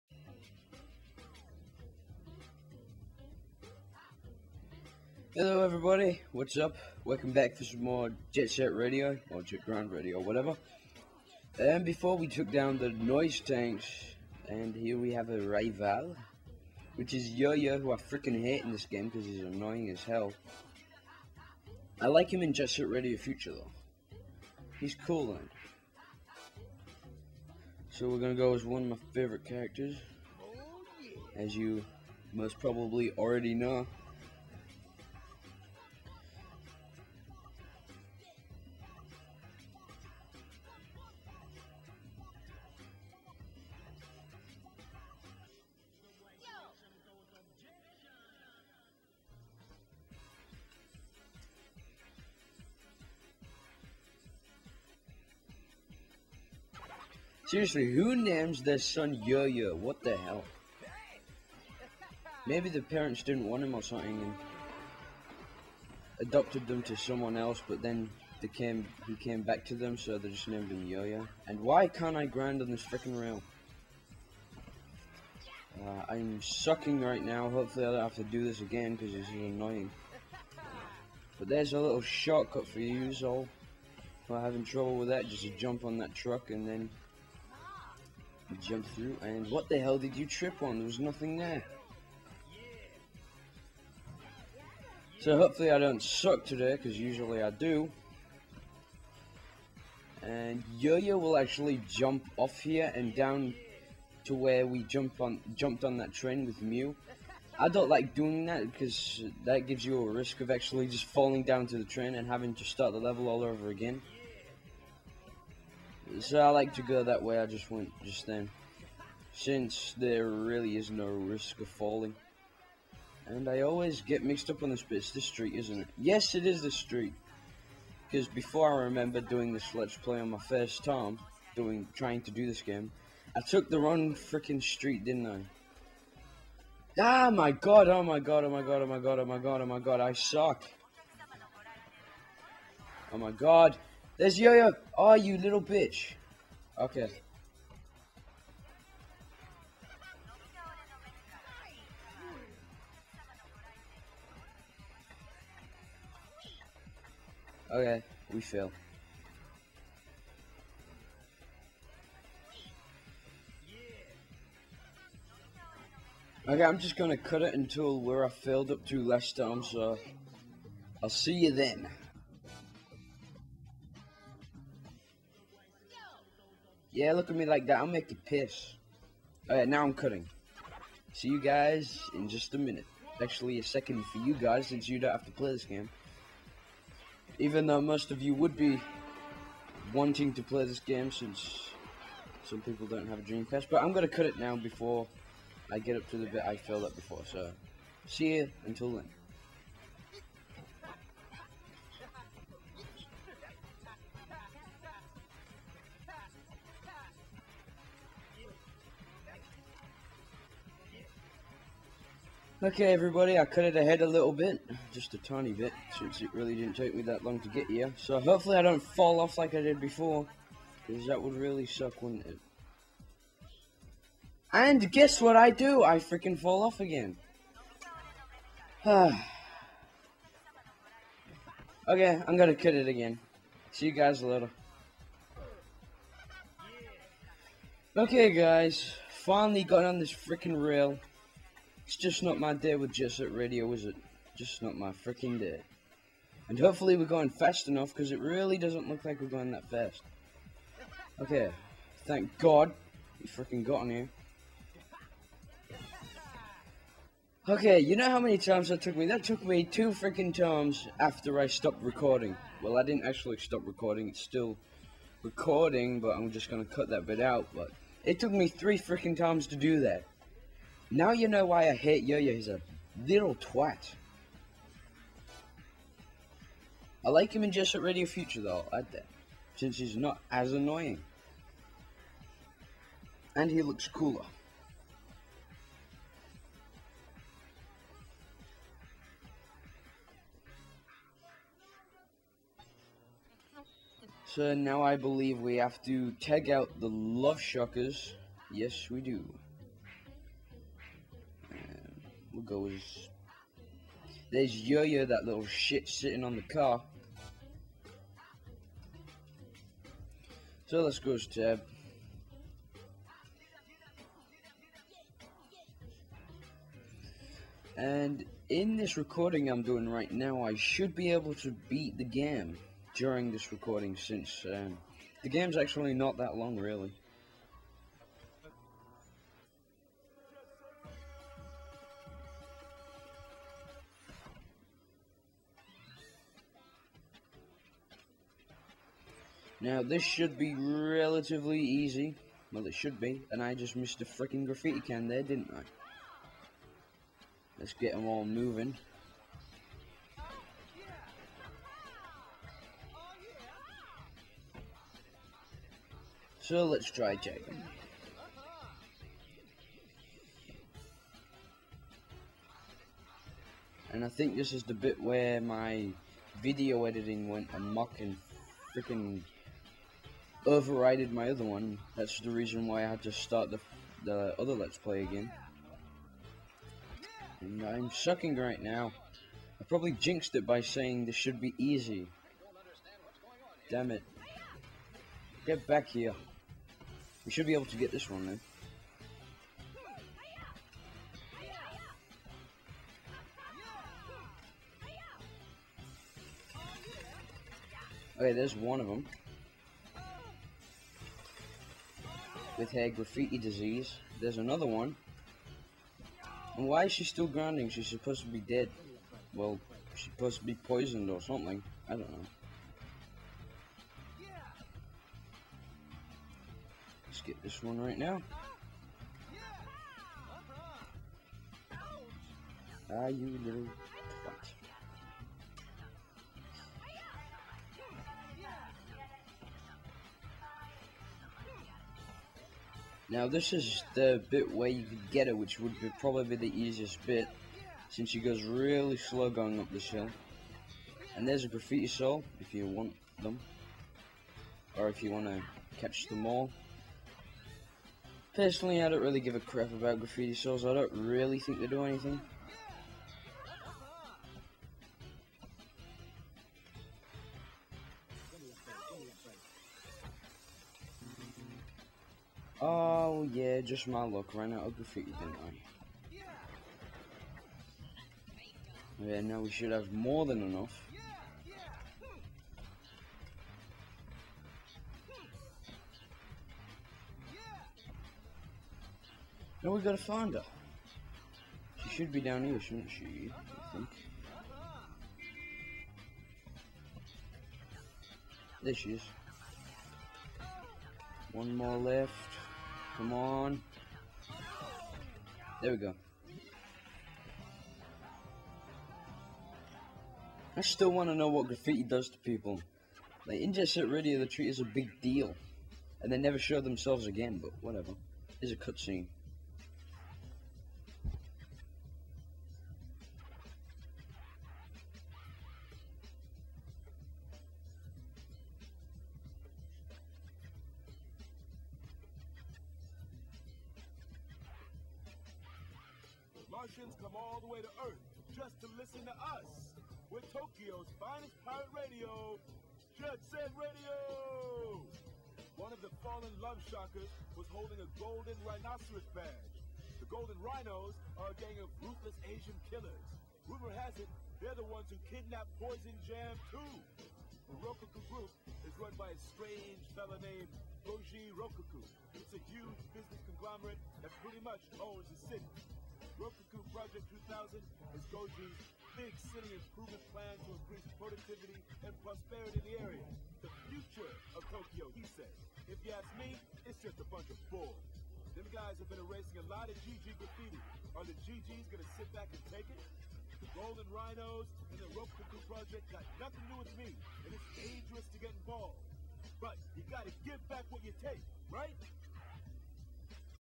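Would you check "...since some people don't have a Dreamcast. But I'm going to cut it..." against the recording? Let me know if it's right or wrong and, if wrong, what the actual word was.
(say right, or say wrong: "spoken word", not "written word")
right.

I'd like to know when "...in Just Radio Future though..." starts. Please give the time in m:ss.
4:37.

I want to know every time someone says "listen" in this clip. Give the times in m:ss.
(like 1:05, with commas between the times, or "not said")
8:48.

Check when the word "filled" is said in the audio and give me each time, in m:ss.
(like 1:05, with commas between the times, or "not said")
2:48.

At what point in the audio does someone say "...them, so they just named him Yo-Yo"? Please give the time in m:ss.
1:09.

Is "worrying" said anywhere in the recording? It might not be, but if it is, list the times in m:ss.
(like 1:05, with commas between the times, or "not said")
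not said.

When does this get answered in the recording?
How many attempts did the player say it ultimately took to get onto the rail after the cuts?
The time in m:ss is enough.
4:28.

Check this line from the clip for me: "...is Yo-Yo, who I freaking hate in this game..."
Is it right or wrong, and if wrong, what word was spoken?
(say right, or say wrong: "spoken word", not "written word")
right.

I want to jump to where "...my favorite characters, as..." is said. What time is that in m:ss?
0:28.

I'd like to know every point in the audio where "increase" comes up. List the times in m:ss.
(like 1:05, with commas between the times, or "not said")
9:20.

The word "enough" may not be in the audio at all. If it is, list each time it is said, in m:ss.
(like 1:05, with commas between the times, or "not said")
4:07, 7:50.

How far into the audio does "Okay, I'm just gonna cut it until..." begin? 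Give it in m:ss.
2:46.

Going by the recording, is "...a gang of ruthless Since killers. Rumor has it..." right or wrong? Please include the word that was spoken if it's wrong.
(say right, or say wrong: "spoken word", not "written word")
wrong: "Asian", not "Since".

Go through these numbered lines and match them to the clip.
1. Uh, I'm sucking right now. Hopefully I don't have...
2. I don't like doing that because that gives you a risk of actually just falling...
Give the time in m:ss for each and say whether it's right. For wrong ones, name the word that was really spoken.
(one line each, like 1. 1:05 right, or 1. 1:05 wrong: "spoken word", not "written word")
1. 1:15 right
2. 1:47 right.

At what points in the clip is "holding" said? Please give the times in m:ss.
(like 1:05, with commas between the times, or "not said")
8:57.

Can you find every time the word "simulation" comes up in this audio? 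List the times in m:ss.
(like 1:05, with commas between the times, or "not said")
not said.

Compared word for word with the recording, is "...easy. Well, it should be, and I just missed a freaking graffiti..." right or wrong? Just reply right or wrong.
right.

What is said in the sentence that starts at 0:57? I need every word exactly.
Seriously, who names their son Yo-Yo?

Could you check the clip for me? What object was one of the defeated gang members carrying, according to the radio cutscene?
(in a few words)
golden rhinoceros badge.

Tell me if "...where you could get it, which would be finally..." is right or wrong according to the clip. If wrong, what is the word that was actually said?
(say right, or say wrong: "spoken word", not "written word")
wrong: "probably", not "finally".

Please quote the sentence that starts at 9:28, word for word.
Them guys have been erasing a lot of GG graffiti.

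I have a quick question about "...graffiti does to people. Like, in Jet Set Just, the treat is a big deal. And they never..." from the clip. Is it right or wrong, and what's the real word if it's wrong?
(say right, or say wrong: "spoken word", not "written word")
wrong: "Radio", not "Just".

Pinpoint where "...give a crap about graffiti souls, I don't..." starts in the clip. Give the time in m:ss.
7:29.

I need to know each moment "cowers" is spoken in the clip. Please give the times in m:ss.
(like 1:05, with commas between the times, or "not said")
not said.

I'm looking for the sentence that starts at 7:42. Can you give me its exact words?
Oh, Oh yeah, just my luck.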